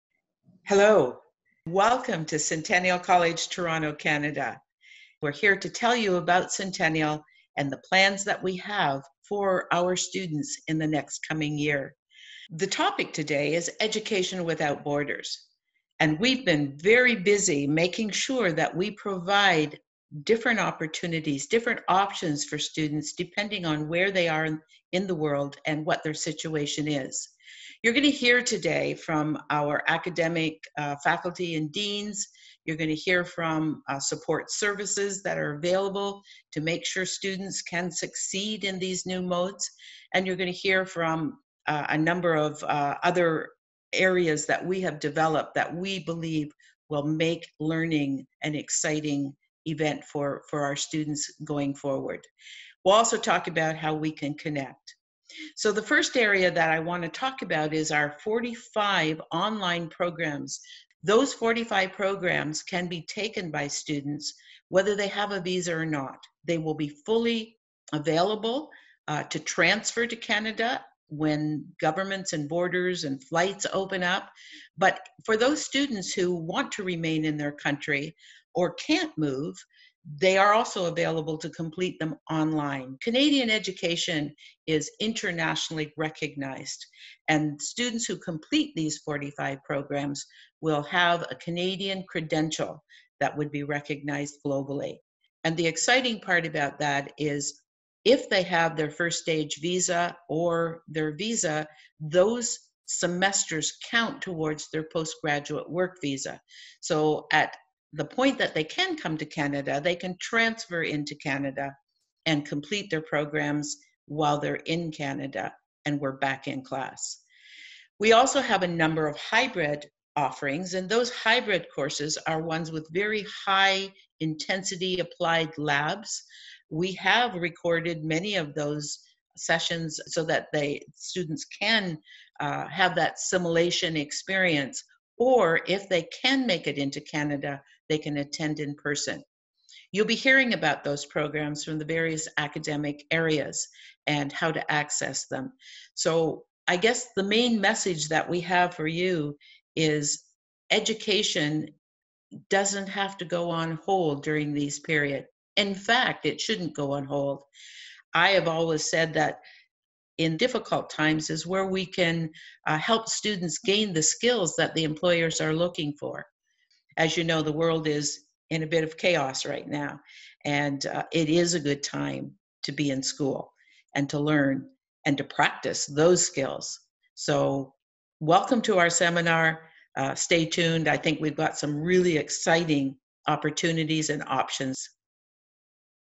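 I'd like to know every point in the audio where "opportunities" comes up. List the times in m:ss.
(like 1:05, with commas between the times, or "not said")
0:20, 3:03.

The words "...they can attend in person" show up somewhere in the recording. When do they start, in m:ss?
2:17.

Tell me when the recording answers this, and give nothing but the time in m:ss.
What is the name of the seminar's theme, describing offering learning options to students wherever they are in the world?
0:13.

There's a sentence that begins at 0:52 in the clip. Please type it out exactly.
We'll also talk about how we can connect.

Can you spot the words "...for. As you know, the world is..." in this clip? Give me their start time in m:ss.
2:45.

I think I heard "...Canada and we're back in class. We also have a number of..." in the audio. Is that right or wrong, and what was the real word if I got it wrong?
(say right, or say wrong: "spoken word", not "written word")
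right.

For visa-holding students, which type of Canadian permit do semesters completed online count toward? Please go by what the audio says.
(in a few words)
postgraduate work visa.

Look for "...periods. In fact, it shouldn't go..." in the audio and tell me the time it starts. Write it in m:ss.
2:34.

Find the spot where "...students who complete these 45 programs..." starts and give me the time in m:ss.
1:27.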